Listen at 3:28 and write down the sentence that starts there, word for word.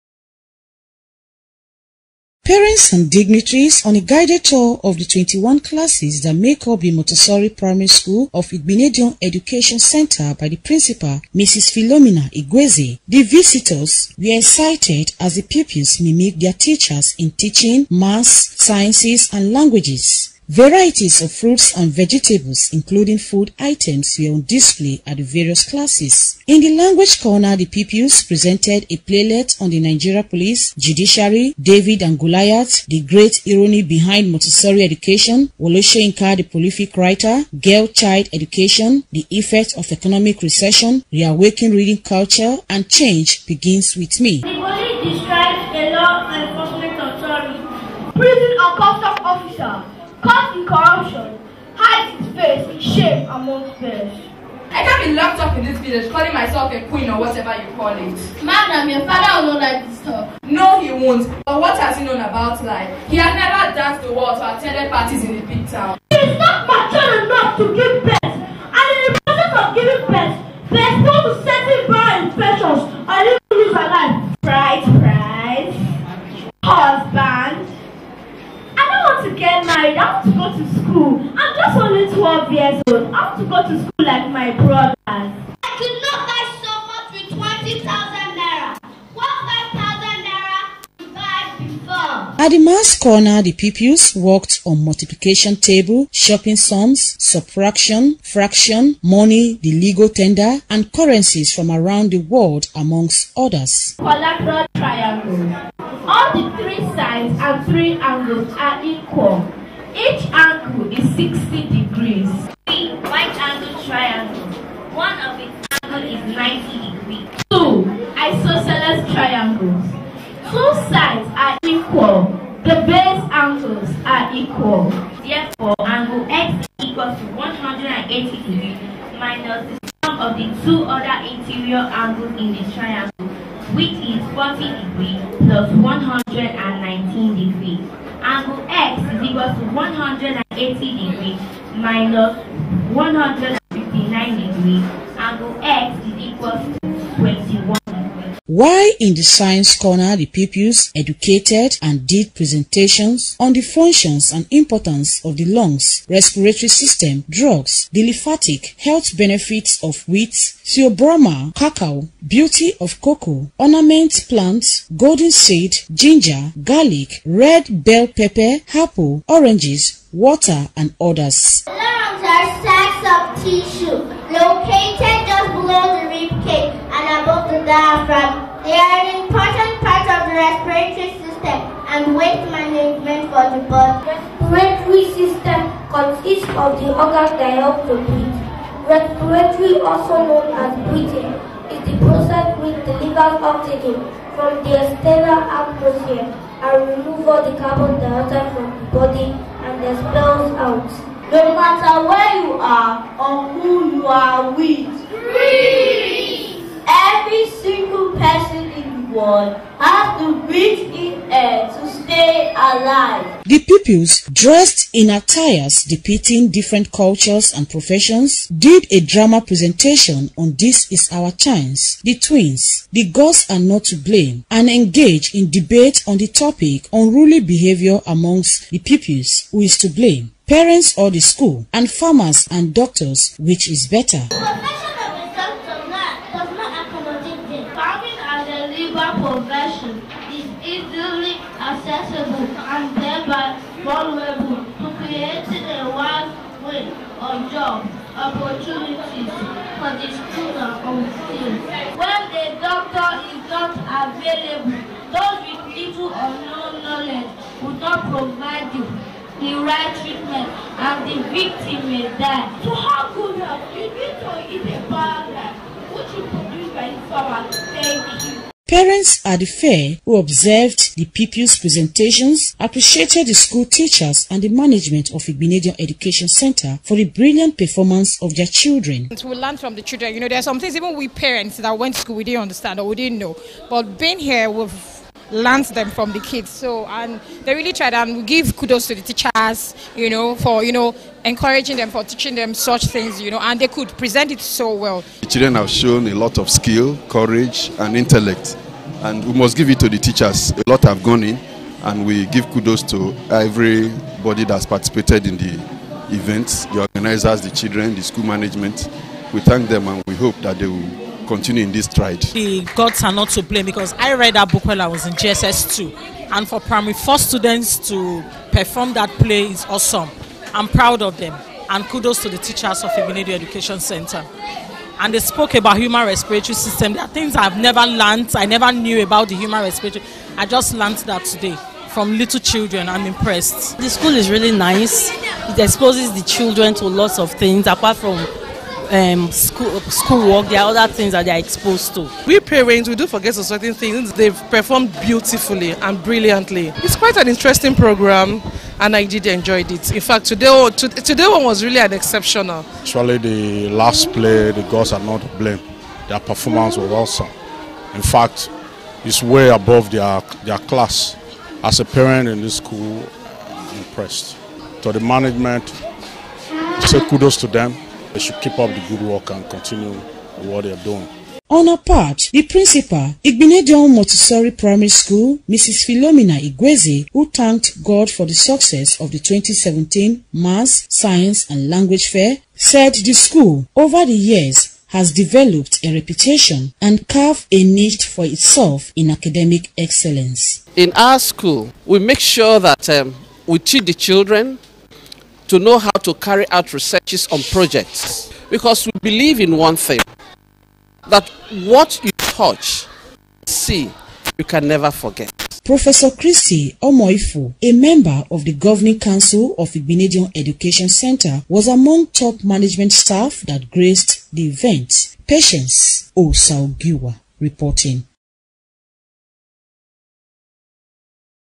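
person in has to breathe in air to stay alive.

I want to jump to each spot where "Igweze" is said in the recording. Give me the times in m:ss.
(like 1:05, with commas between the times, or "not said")
0:12, 6:16.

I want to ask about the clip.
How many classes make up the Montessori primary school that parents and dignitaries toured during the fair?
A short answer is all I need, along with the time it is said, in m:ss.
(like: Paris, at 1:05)
21, at 0:05.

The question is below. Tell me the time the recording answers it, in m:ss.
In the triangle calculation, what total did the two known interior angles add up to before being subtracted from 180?
2:22.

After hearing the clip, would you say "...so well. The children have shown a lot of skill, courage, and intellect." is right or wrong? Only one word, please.
right.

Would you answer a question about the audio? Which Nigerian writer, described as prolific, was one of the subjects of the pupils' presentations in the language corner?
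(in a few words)
Wole Soyinka.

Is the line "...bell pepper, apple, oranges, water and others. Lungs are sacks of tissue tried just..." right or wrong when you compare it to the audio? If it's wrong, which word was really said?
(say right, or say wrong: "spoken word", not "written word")
wrong: "located", not "tried".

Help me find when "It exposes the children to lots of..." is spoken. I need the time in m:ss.
5:35.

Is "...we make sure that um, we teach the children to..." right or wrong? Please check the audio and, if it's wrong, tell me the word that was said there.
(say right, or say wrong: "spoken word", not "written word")
right.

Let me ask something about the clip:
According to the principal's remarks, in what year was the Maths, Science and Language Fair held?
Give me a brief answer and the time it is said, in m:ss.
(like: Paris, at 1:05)
2017, at 6:19.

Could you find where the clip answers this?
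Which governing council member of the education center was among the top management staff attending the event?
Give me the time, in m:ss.
6:45.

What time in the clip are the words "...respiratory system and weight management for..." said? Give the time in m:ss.
3:00.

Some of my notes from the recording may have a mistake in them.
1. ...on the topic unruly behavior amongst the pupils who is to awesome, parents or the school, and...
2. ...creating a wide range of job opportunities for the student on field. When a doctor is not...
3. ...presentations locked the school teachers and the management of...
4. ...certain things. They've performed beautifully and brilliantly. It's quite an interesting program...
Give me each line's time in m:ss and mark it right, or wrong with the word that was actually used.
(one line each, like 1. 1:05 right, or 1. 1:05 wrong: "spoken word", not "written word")
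1. 3:46 wrong: "blame", not "awesome"
2. 4:05 right
3. 4:31 wrong: "appreciated", not "locked"
4. 5:43 right.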